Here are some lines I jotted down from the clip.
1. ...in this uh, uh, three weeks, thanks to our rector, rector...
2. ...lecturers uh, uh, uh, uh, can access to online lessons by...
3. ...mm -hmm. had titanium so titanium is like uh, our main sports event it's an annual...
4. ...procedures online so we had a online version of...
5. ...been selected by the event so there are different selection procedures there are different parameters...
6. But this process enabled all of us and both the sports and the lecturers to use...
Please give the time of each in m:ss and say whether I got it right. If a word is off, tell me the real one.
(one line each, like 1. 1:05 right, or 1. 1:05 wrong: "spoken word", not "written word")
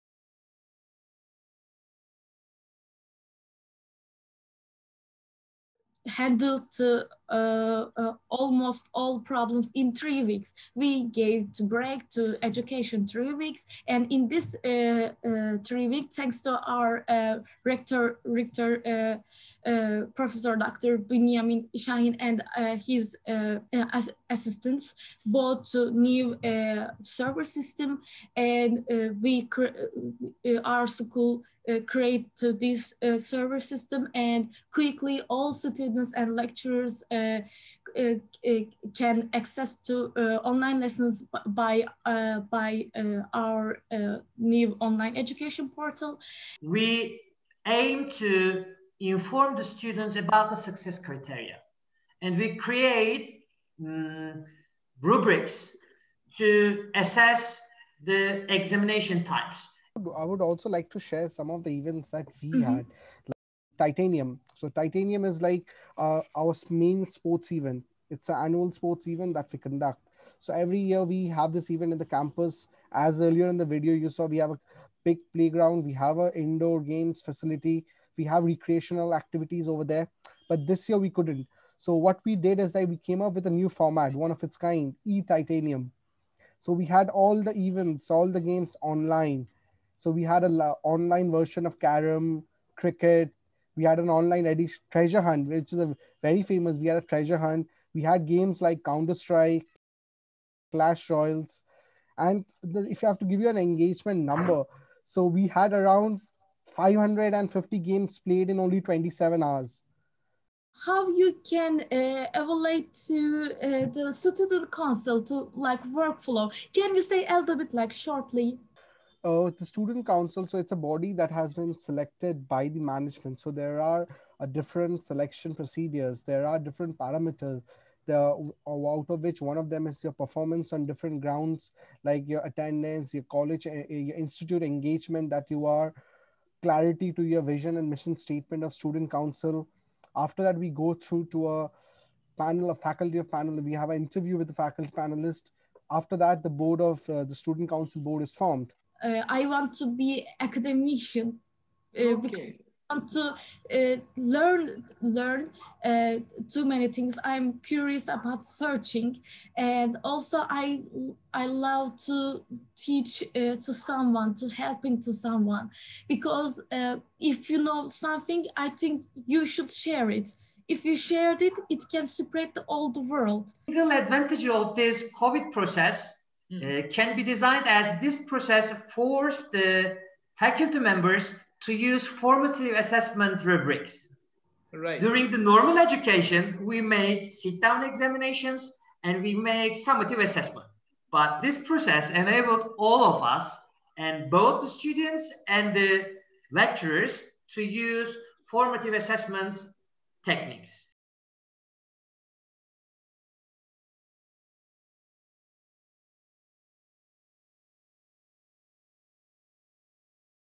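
1. 0:14 right
2. 0:36 right
3. 1:02 right
4. 1:28 wrong: "games", not "procedures"
5. 2:01 wrong: "management", not "event"
6. 3:11 wrong: "students", not "sports".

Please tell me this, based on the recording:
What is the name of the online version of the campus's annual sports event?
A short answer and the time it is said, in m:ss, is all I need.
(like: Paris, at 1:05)
e-titanium, at 1:25.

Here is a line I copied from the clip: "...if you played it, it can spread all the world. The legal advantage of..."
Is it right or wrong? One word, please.
wrong.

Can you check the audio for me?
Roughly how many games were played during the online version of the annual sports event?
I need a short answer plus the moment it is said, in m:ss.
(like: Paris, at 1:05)
550, at 1:46.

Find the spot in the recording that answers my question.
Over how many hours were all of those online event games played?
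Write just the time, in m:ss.
1:48.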